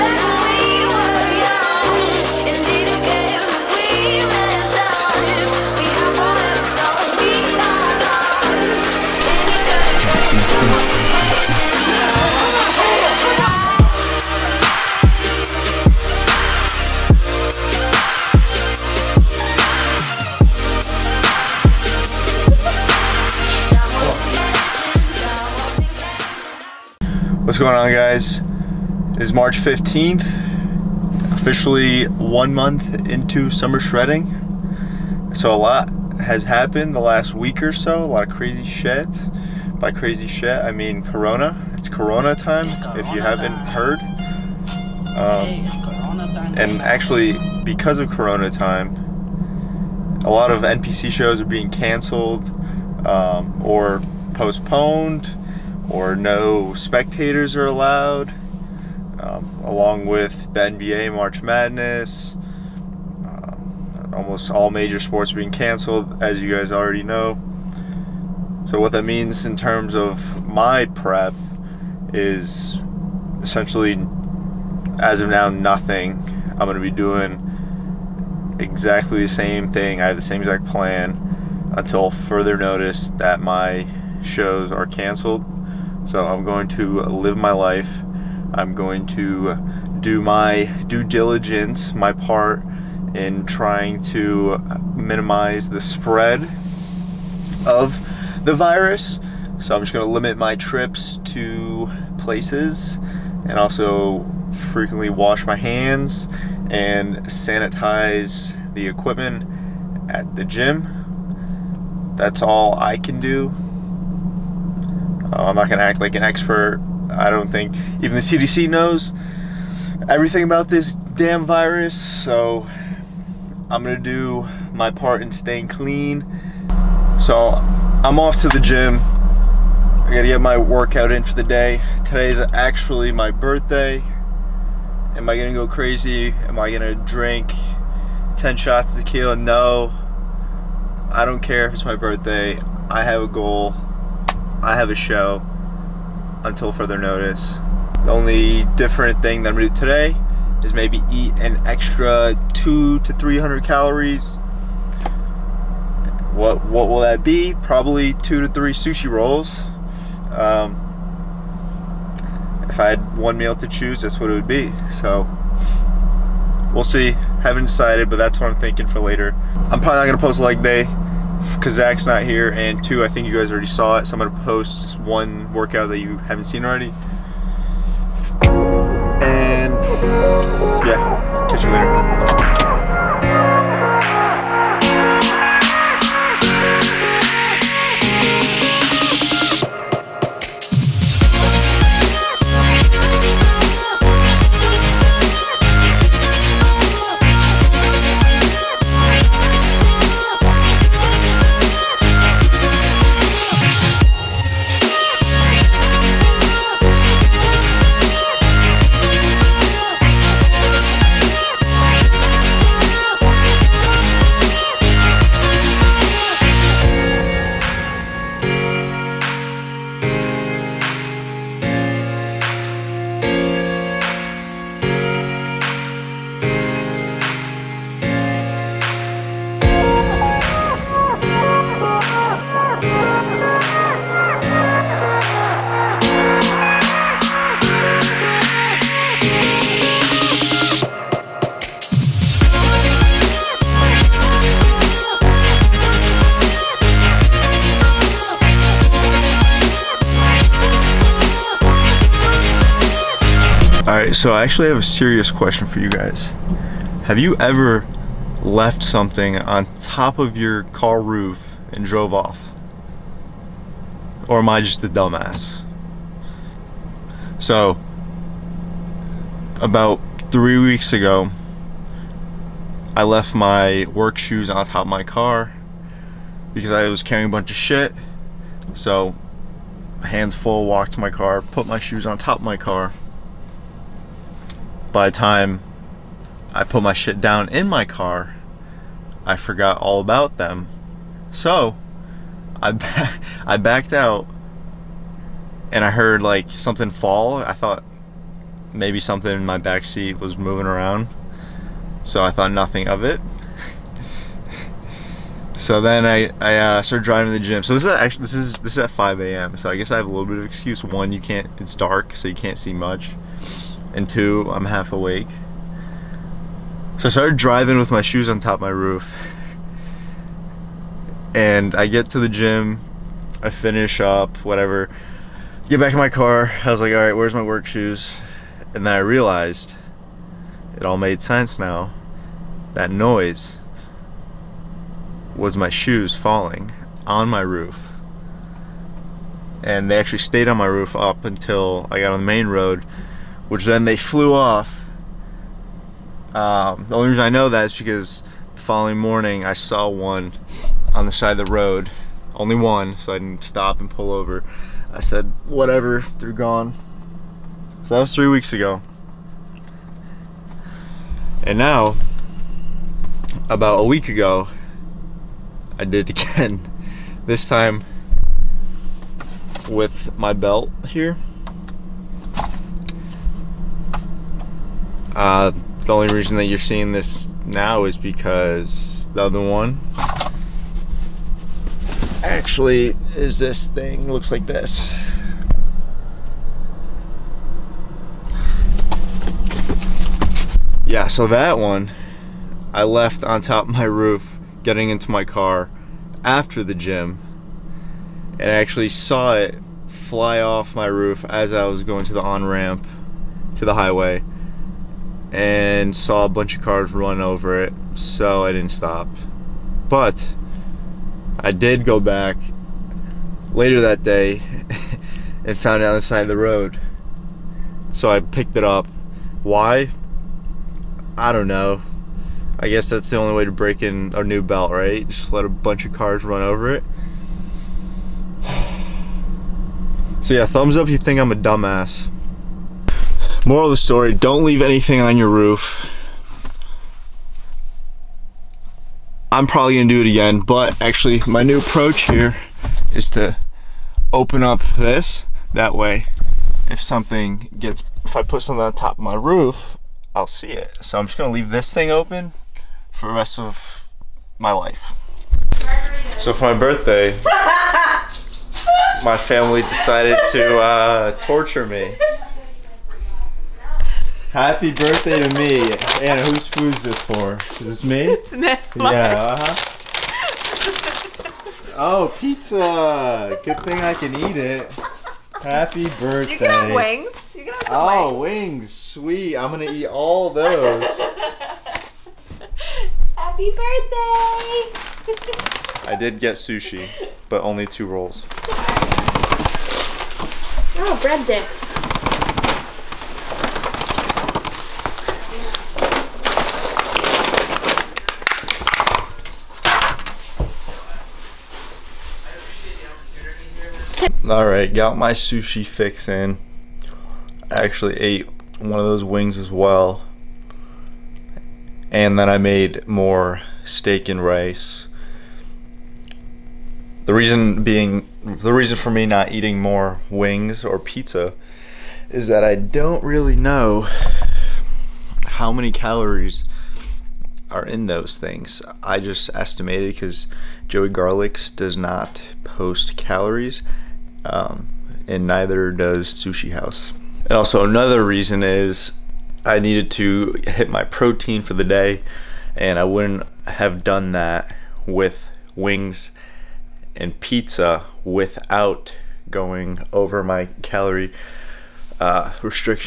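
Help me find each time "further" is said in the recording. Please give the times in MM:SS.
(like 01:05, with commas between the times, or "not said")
01:22, 02:26.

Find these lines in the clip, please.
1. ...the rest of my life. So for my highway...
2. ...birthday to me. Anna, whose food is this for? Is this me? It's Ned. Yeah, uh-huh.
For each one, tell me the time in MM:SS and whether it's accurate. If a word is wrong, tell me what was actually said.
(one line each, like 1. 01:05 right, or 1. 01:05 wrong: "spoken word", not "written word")
1. 07:33 wrong: "birthday", not "highway"
2. 07:44 right.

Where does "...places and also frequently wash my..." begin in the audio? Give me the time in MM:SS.
01:42.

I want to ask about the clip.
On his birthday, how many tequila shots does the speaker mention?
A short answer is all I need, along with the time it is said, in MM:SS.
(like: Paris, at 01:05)
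10, at 02:18.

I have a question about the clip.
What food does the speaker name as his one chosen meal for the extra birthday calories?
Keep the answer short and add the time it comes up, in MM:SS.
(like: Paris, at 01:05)
Sushi rolls, at 02:38.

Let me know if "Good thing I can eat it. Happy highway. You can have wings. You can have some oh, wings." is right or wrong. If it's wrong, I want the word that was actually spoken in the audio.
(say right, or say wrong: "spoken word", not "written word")
wrong: "birthday", not "highway".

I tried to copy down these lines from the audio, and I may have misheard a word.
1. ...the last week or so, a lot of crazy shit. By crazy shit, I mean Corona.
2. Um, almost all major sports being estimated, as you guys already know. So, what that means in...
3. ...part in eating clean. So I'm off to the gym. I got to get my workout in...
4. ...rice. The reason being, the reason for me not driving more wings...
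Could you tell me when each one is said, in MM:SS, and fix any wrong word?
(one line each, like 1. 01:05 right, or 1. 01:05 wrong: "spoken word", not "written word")
1. 00:36 right
2. 01:02 wrong: "canceled", not "estimated"
3. 02:04 wrong: "staying", not "eating"
4. 08:34 wrong: "eating", not "driving".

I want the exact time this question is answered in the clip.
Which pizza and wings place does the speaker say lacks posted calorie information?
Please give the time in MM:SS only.
08:50.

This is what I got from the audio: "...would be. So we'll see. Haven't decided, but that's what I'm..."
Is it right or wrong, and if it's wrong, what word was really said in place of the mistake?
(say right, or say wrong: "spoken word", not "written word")
right.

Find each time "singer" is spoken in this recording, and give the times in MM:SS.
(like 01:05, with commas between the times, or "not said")
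not said.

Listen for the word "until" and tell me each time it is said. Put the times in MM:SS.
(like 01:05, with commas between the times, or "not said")
01:21, 02:26, 05:41.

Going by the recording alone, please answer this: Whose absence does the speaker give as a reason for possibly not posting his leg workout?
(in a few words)
Zach.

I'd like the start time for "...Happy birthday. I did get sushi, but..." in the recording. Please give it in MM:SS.
08:03.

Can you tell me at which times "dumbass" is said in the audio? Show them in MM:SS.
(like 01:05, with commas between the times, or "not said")
04:24, 07:11.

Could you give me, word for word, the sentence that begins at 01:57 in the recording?
I don't think even the CDC knows everything about this damn virus.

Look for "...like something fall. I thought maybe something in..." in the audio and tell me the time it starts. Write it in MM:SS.
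04:56.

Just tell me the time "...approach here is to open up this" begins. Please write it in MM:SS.
07:21.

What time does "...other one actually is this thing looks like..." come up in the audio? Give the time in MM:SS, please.
06:19.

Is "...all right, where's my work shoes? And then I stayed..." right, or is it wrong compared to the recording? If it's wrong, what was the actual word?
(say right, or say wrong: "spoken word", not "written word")
wrong: "realized", not "stayed".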